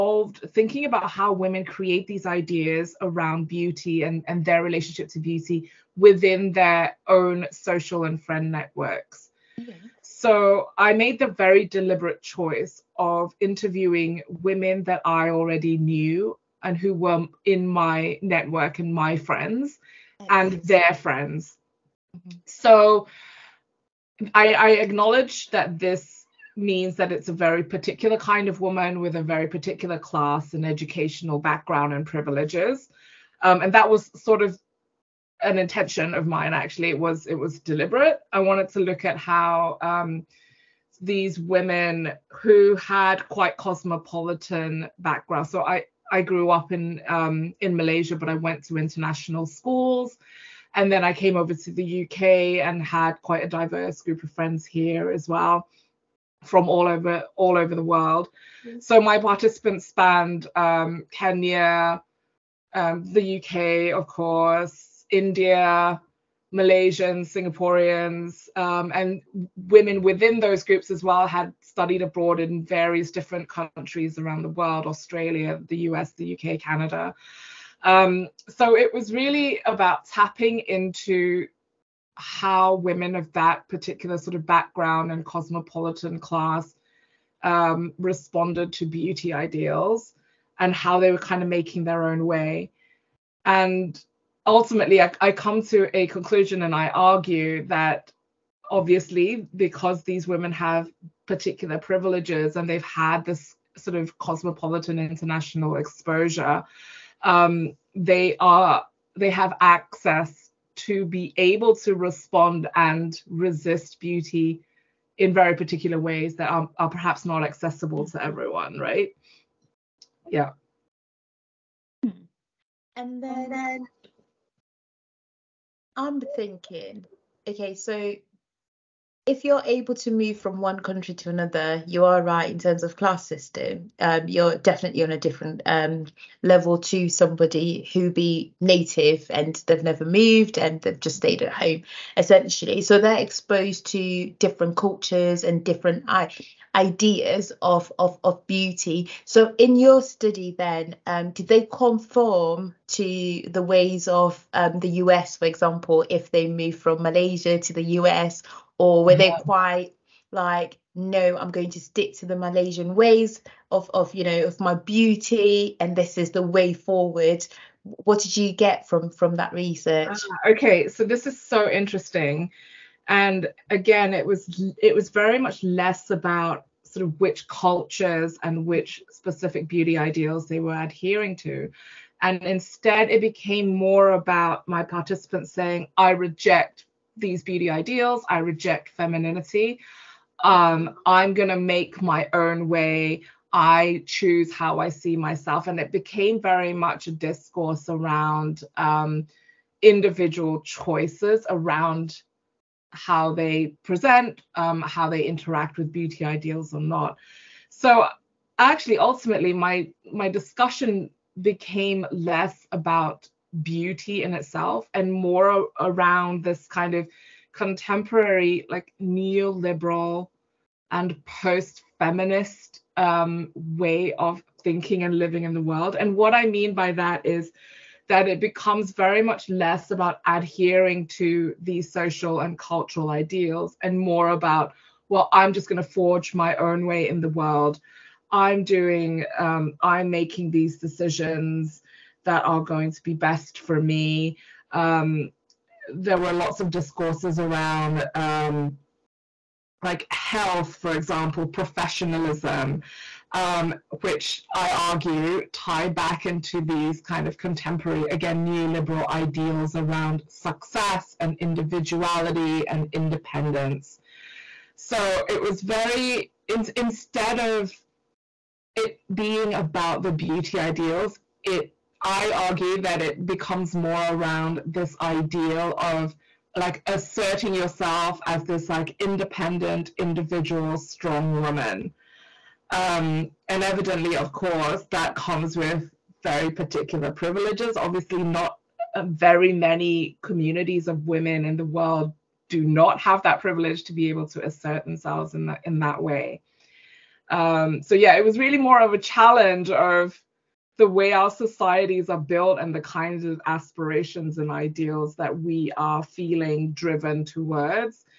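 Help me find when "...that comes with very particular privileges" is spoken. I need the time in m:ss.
4:44.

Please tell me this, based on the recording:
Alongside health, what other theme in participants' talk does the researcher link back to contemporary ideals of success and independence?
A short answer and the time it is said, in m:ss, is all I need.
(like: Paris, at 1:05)
professionalism, at 4:11.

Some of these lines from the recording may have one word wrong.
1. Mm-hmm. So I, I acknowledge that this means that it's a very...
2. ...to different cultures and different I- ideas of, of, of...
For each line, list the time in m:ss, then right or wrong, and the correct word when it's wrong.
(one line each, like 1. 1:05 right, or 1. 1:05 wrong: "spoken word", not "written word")
1. 0:22 right
2. 2:23 right.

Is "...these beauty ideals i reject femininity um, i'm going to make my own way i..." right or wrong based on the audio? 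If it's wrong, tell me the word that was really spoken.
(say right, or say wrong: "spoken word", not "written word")
right.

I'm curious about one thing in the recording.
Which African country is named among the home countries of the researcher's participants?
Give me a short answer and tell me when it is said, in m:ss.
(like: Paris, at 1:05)
Kenya, at 1:01.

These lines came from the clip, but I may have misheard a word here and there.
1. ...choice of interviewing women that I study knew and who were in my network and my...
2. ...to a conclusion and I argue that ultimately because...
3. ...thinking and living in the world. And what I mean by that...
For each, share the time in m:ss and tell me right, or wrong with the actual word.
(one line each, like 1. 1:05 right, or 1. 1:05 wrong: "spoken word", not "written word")
1. 0:12 wrong: "already", not "study"
2. 1:35 wrong: "obviously", not "ultimately"
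3. 3:44 right.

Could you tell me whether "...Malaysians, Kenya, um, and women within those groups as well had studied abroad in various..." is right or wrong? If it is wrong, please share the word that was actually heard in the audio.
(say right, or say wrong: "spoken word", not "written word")
wrong: "Singaporeans", not "Kenya".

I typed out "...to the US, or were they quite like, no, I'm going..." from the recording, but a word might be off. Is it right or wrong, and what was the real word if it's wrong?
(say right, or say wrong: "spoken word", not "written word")
right.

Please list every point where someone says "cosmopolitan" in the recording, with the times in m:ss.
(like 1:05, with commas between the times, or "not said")
0:43, 1:25, 1:44.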